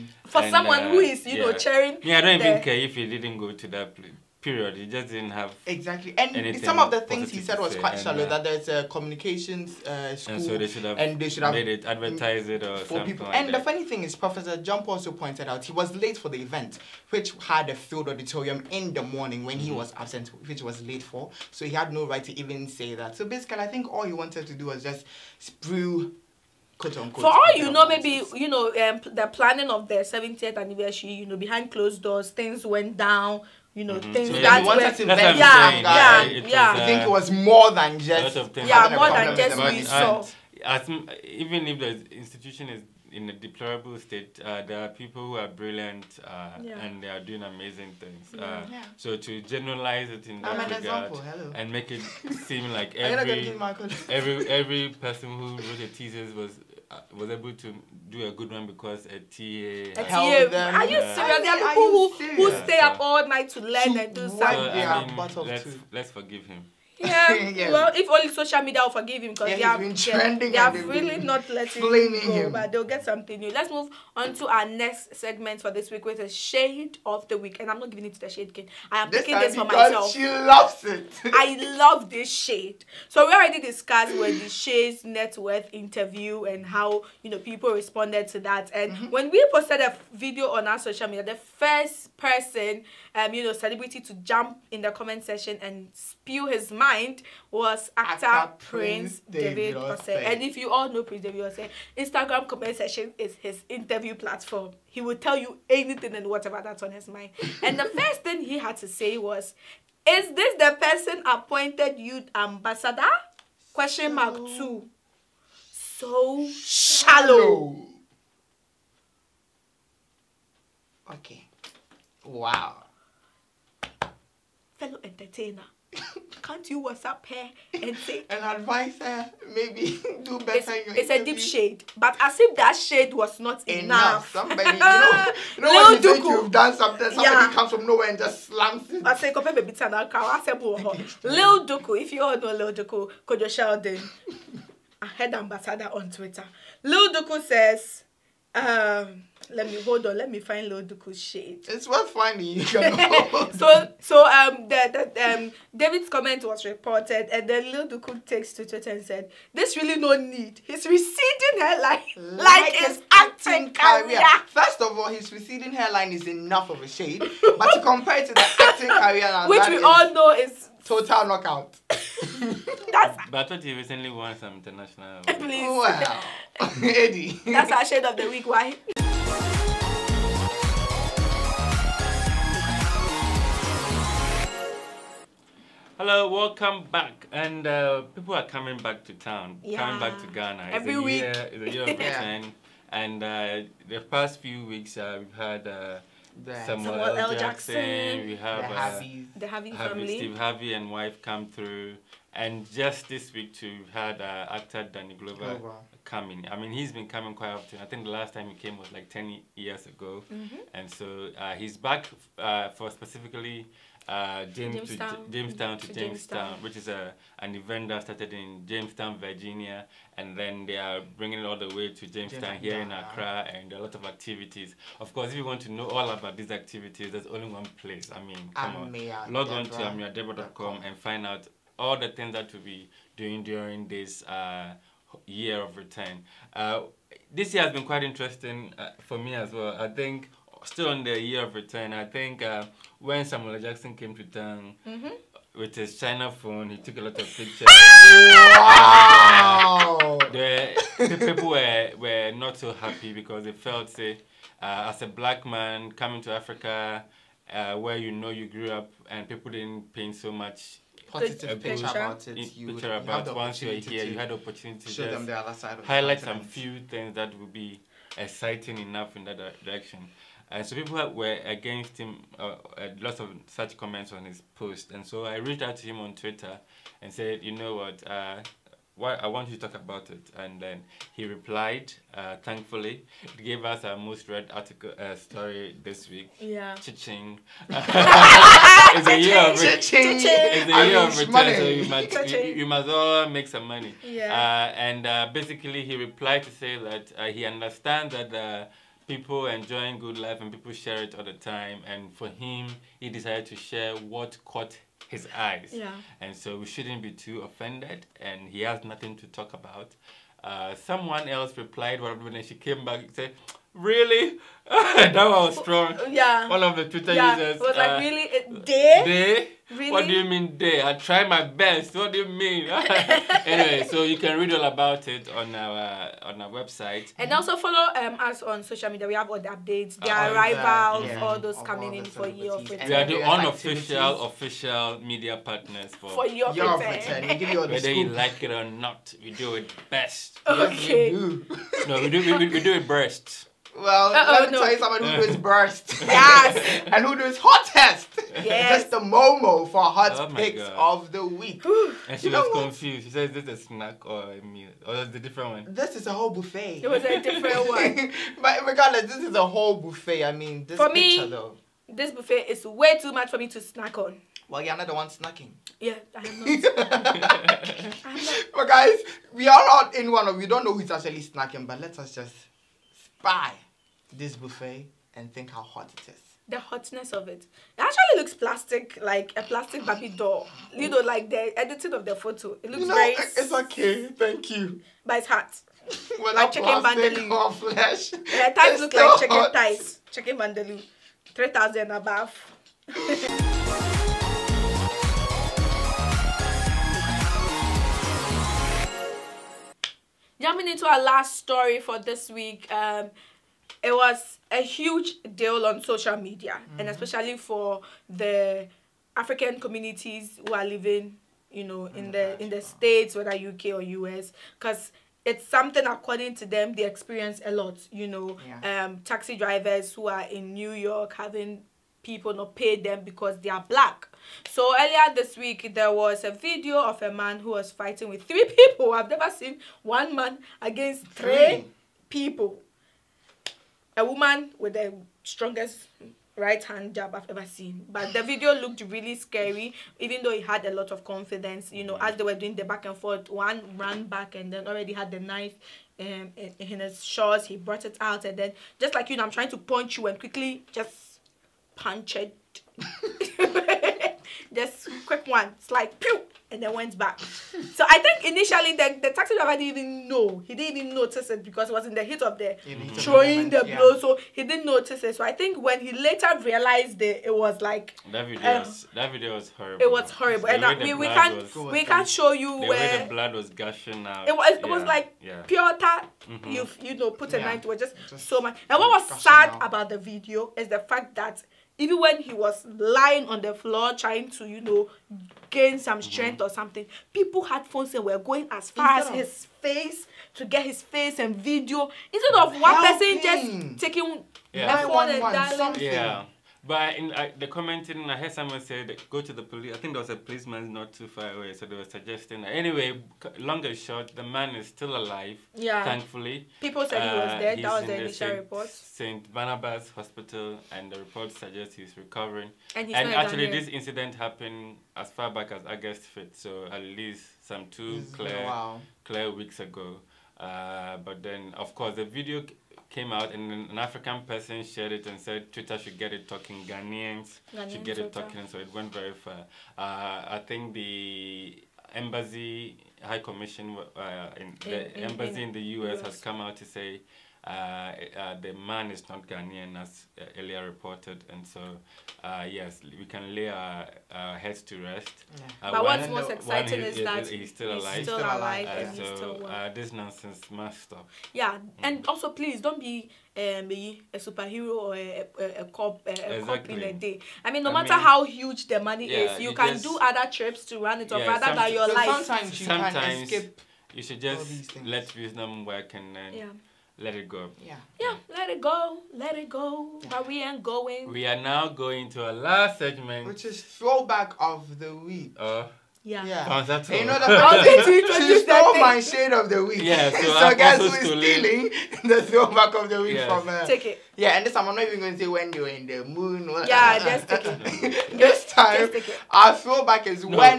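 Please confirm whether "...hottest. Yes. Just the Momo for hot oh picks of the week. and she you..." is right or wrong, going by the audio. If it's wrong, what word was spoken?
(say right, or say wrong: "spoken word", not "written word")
right.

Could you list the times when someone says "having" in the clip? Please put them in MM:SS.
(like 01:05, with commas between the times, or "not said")
07:01.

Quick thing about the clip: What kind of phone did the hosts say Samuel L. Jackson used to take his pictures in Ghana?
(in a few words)
China phone.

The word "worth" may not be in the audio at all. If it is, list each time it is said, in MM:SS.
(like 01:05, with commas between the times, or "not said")
01:25, 02:31.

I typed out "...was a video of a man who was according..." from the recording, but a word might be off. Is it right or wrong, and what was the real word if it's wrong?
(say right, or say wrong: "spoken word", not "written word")
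wrong: "fighting", not "according".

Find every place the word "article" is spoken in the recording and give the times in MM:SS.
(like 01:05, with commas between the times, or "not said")
04:44.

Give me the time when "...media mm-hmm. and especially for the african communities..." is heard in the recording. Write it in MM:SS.
06:46.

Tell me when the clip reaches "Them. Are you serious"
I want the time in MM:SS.
01:00.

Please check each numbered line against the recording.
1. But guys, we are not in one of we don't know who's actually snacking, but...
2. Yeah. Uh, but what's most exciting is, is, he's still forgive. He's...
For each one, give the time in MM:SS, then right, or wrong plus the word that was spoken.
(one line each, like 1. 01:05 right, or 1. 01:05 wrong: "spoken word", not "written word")
1. 06:08 right
2. 09:05 wrong: "alive", not "forgive".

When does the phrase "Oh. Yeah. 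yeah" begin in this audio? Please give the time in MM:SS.
09:35.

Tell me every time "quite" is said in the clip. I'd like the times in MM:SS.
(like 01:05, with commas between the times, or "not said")
00:07, 03:27, 03:57.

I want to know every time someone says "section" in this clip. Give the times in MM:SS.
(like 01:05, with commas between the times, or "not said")
01:35, 01:42.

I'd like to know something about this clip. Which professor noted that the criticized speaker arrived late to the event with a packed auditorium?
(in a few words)
Professor Gyampo.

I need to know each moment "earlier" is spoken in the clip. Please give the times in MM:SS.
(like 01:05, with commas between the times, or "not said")
07:04, 09:00.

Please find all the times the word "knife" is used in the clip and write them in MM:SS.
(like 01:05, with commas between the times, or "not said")
07:25, 07:57.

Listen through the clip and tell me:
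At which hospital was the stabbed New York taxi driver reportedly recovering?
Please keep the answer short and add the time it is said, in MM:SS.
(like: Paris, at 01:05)
St. Barnabas Hospital, at 08:28.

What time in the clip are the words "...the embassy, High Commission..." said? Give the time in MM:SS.
08:50.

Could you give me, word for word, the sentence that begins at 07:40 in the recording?
He didn't even notice it because it was in the heat of the mm throwing the, moment, the blow.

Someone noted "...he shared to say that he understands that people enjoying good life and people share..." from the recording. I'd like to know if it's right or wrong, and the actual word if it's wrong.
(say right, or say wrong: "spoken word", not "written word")
wrong: "replied", not "shared".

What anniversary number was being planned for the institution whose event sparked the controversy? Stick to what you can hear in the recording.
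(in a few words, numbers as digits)
70th.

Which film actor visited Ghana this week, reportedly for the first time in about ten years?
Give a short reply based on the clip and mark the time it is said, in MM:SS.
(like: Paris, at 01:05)
Danny Glover, at 03:24.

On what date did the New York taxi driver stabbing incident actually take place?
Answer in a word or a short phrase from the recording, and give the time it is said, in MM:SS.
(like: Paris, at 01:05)
August 5th, at 08:35.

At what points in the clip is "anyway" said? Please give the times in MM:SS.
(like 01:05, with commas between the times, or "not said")
05:23, 08:22.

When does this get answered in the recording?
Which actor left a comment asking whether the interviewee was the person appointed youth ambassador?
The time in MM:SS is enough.
01:41.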